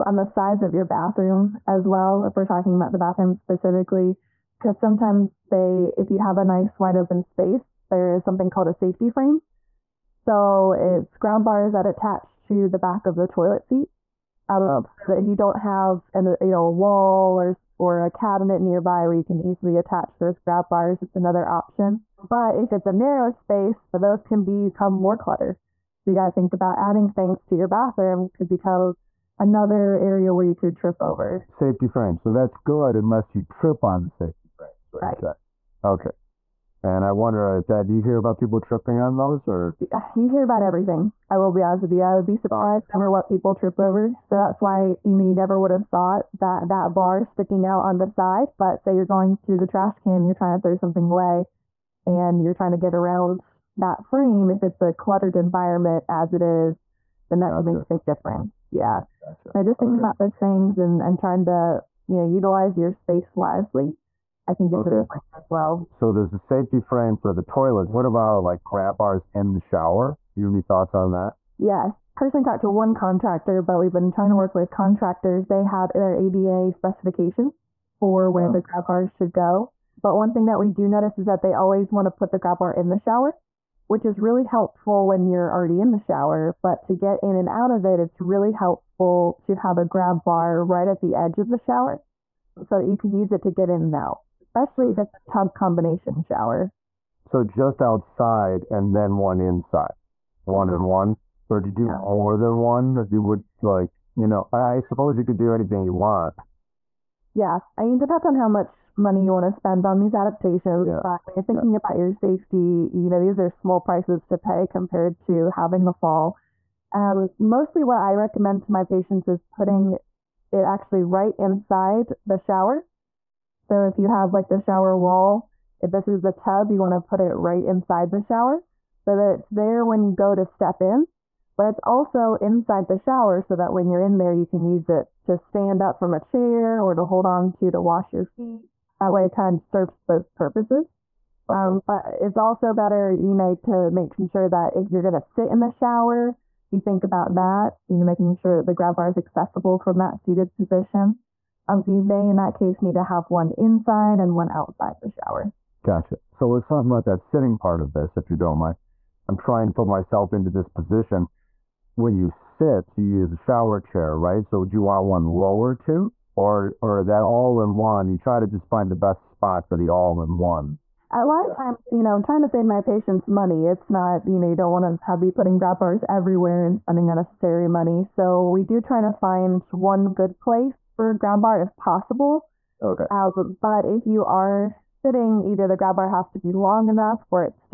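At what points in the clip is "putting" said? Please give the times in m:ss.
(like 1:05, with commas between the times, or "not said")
1:59, 2:55.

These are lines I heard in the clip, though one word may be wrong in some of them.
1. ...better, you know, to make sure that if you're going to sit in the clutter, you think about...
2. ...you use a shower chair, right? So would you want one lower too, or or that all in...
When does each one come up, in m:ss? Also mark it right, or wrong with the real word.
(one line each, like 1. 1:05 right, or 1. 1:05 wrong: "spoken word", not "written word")
1. 2:22 wrong: "shower", not "clutter"
2. 2:42 right.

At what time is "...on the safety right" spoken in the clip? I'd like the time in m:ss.
0:33.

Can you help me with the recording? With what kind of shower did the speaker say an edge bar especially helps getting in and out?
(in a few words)
Tub combination shower.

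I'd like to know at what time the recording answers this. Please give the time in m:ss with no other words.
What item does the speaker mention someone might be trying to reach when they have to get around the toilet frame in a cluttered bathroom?
0:49.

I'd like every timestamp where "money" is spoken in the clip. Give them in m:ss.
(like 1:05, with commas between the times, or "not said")
1:48, 2:53, 2:57.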